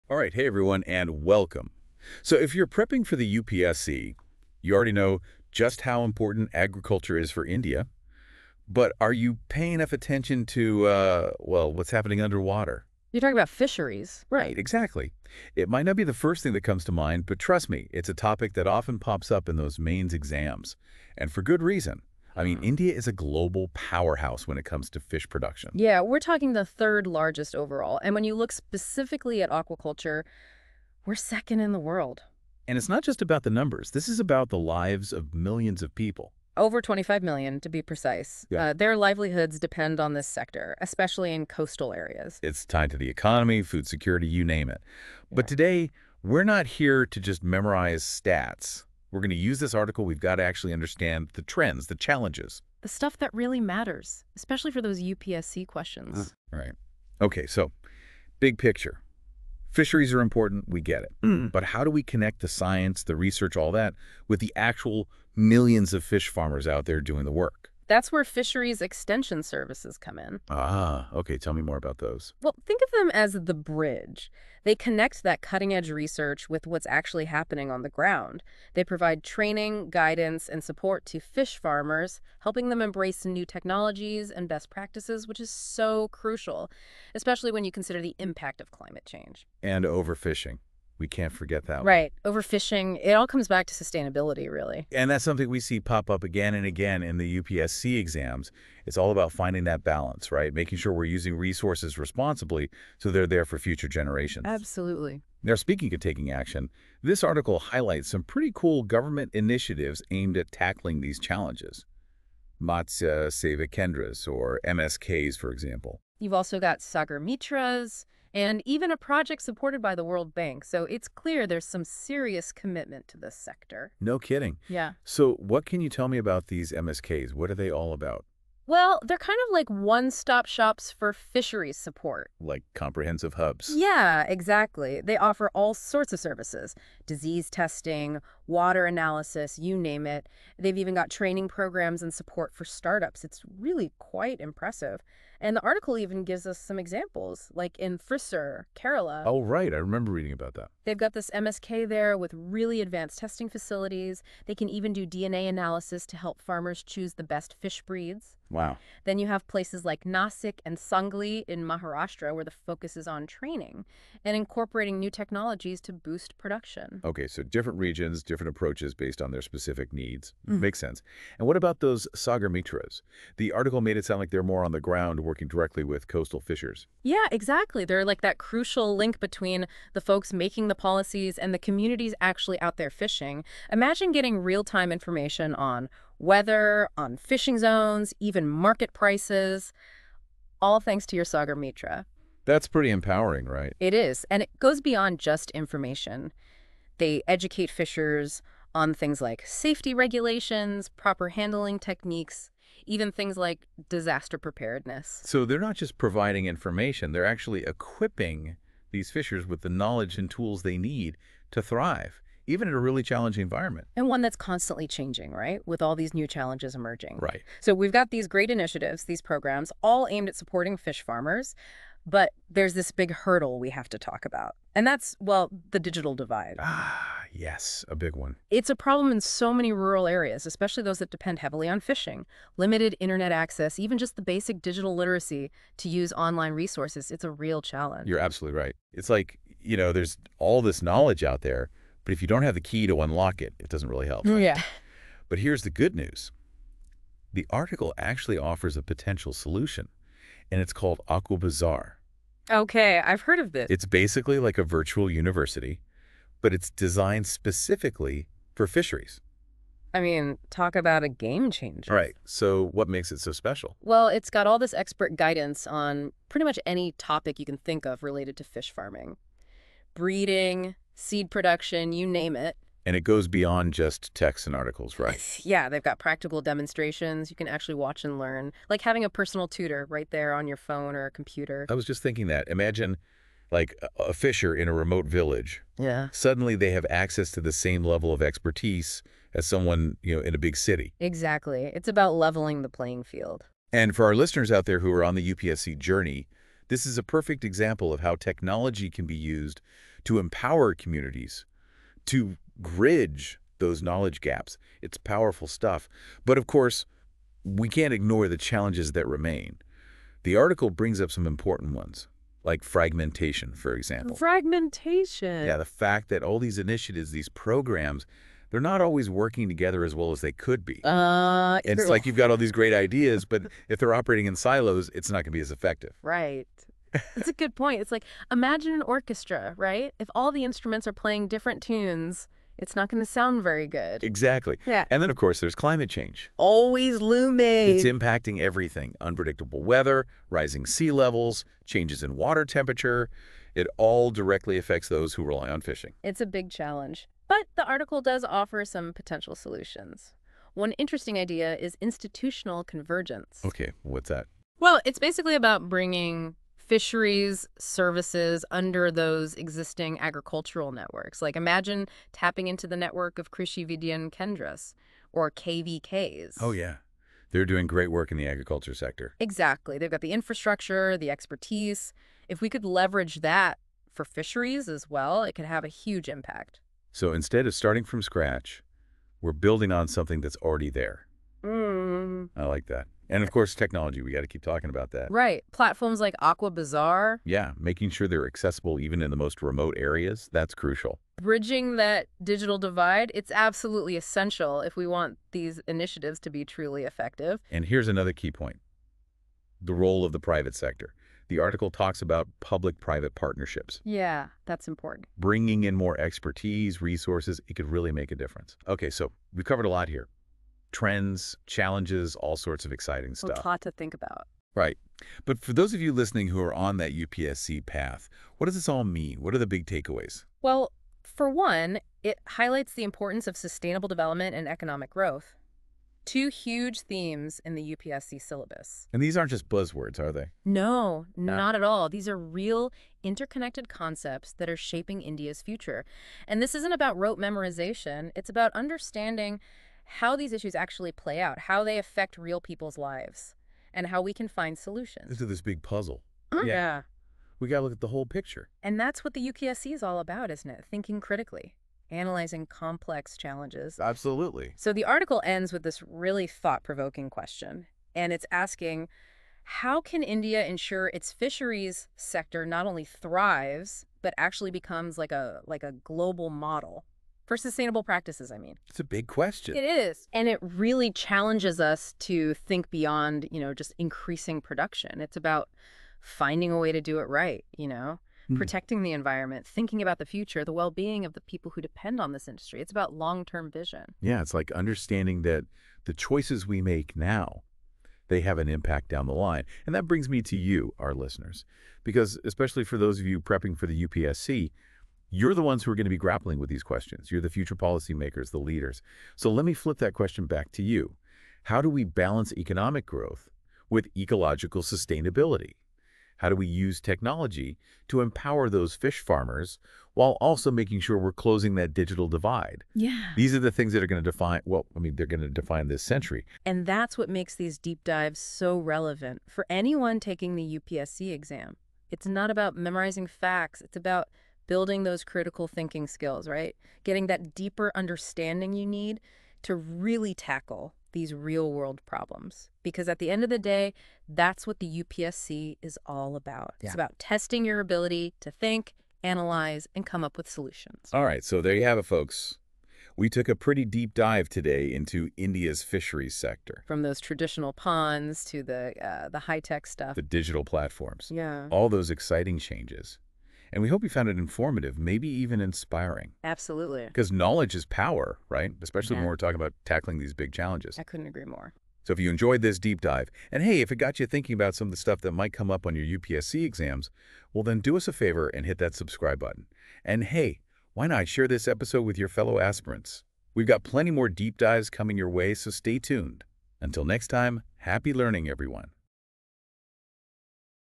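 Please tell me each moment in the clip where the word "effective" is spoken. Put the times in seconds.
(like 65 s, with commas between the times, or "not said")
325 s, 396 s.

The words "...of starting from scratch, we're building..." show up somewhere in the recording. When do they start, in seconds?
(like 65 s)
377 s.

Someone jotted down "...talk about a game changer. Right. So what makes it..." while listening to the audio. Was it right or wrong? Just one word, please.
right.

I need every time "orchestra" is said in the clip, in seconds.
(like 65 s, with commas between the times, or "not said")
328 s.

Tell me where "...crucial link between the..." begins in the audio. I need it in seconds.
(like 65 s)
178 s.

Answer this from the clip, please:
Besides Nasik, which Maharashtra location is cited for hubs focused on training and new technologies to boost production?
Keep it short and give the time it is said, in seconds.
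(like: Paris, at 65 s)
Sangli, at 160 s.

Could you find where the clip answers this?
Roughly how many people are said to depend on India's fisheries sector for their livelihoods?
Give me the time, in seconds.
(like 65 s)
36 s.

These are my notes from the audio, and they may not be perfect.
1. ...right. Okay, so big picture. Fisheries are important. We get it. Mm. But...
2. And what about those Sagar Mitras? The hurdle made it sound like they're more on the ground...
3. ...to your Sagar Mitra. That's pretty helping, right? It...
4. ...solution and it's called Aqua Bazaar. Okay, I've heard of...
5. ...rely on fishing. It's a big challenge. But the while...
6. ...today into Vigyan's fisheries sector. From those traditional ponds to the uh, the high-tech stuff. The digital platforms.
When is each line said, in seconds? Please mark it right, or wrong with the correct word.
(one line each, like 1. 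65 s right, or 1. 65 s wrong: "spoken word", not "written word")
1. 56 s right
2. 171 s wrong: "article", not "hurdle"
3. 191 s wrong: "empowering", not "helping"
4. 249 s right
5. 345 s wrong: "article", not "while"
6. 544 s wrong: "India", not "Vigyan".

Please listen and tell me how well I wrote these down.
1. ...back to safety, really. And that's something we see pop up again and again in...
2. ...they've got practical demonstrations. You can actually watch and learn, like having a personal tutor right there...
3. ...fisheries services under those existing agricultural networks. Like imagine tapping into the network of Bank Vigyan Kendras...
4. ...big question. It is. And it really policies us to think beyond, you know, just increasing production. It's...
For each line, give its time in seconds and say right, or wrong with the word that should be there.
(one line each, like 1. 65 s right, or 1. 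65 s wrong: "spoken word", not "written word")
1. 93 s wrong: "sustainability", not "safety"
2. 275 s right
3. 356 s wrong: "Krishi", not "Bank"
4. 468 s wrong: "challenges", not "policies".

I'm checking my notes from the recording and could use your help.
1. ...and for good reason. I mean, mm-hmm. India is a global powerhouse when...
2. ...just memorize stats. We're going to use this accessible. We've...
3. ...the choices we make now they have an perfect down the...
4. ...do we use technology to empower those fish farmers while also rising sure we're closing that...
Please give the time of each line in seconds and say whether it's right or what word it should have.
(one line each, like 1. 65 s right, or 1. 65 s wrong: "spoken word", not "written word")
1. 21 s right
2. 47 s wrong: "article", not "accessible"
3. 485 s wrong: "impact", not "perfect"
4. 506 s wrong: "making", not "rising".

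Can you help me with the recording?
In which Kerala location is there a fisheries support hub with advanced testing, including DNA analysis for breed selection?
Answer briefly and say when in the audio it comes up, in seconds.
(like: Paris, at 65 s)
Thrissur, at 147 s.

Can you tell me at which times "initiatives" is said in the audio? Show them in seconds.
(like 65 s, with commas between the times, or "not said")
109 s, 218 s, 316 s, 395 s.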